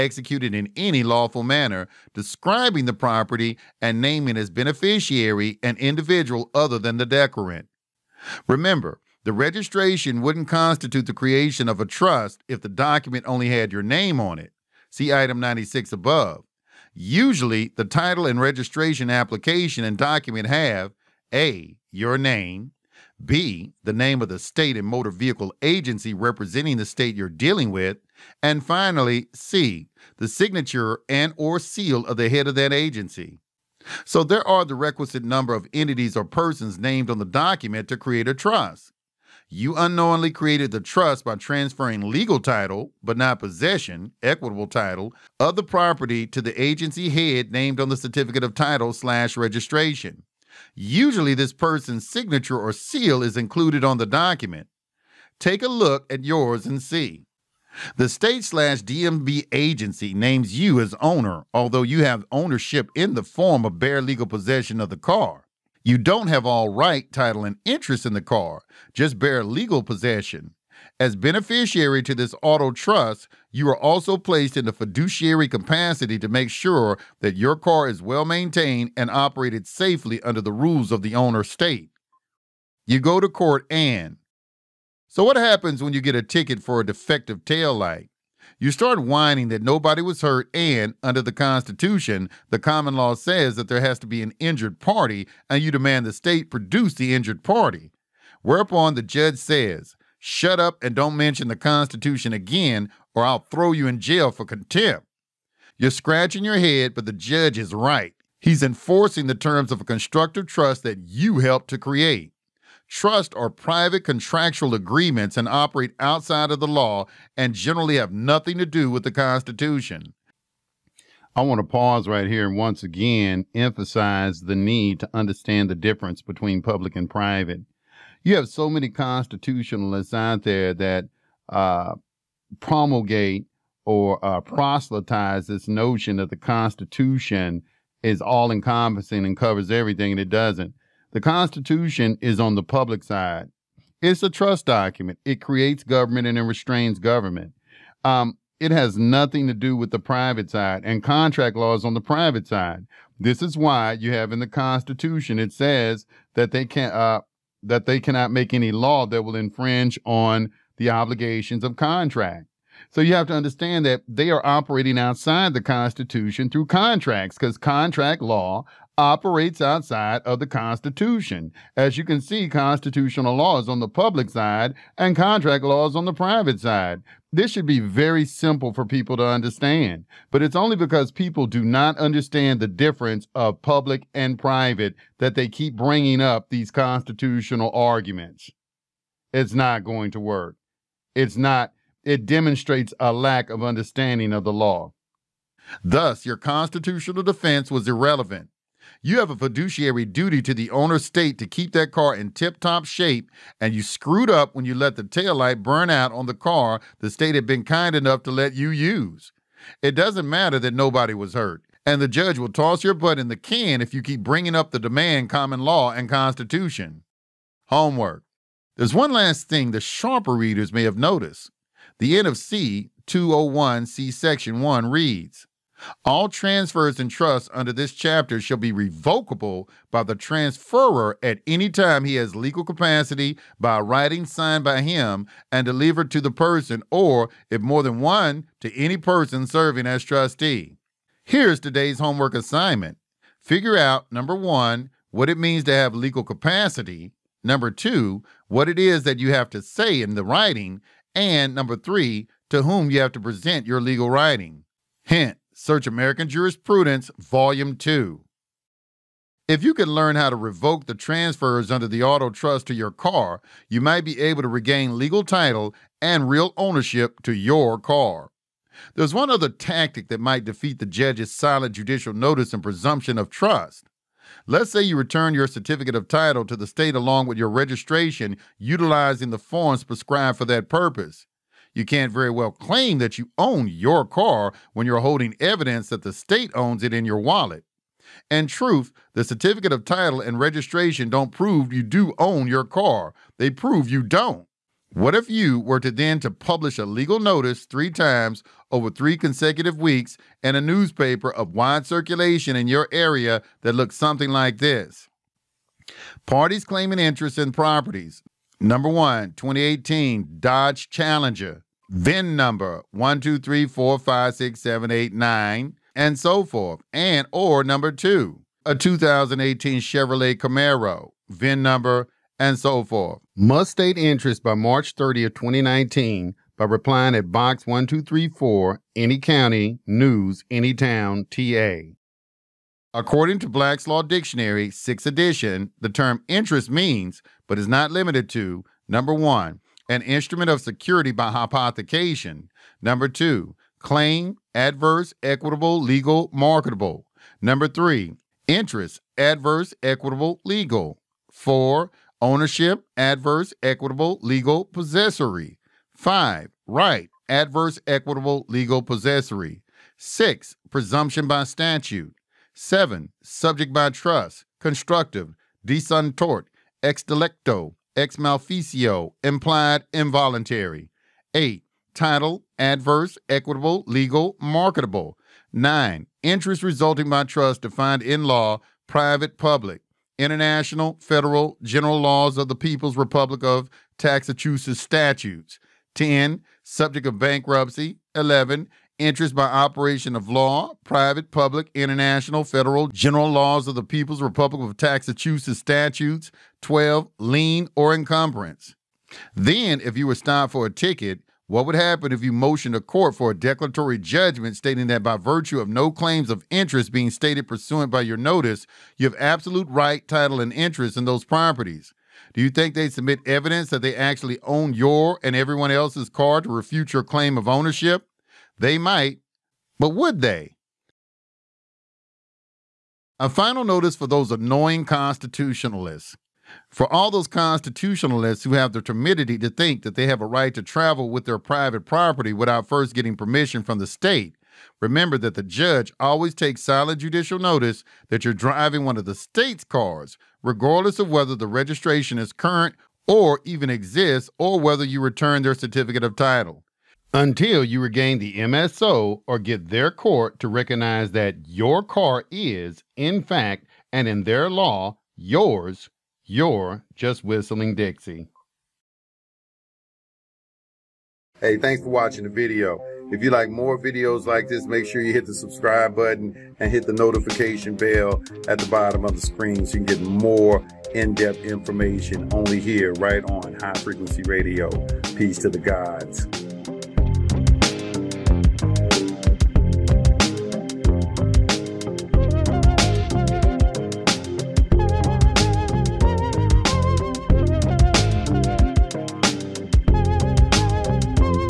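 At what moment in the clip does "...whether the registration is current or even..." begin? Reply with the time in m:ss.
7:21.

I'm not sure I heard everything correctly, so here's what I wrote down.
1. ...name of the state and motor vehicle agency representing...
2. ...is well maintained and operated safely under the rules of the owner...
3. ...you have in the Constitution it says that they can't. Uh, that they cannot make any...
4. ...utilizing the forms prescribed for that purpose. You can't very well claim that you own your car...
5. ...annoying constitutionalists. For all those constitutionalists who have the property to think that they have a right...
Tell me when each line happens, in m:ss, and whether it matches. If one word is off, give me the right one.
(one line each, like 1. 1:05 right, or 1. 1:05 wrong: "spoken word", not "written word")
1. 0:23 right
2. 1:17 right
3. 2:33 right
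4. 4:38 right
5. 7:04 wrong: "timidity", not "property".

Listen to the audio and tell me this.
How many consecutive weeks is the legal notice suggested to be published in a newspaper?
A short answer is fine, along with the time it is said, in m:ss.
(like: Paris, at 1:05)
3, at 4:58.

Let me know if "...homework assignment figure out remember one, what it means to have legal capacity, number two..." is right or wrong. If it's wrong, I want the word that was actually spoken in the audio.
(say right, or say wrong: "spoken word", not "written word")
wrong: "number", not "remember".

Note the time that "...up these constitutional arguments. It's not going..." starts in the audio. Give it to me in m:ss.
3:06.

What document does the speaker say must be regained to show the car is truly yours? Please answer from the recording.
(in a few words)
MSO.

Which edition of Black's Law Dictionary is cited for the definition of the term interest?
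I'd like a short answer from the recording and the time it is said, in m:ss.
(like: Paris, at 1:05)
6th edition, at 5:34.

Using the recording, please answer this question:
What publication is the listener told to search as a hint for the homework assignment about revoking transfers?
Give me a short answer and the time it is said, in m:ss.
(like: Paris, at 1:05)
American Jurisprudence, Volume 2, at 4:15.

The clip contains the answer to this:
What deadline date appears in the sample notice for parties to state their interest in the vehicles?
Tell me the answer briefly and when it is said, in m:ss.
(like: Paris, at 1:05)
March 30th, 2019, at 5:24.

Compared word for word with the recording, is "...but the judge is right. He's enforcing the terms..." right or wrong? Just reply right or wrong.
right.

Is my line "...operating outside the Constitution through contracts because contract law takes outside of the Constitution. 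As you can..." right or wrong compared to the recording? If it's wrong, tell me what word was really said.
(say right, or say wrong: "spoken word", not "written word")
wrong: "operates", not "takes".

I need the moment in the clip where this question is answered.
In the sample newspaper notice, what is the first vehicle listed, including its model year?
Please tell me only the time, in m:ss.
5:09.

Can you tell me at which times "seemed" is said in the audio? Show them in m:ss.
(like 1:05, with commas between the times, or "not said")
not said.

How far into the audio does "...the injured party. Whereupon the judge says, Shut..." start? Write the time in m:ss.
1:36.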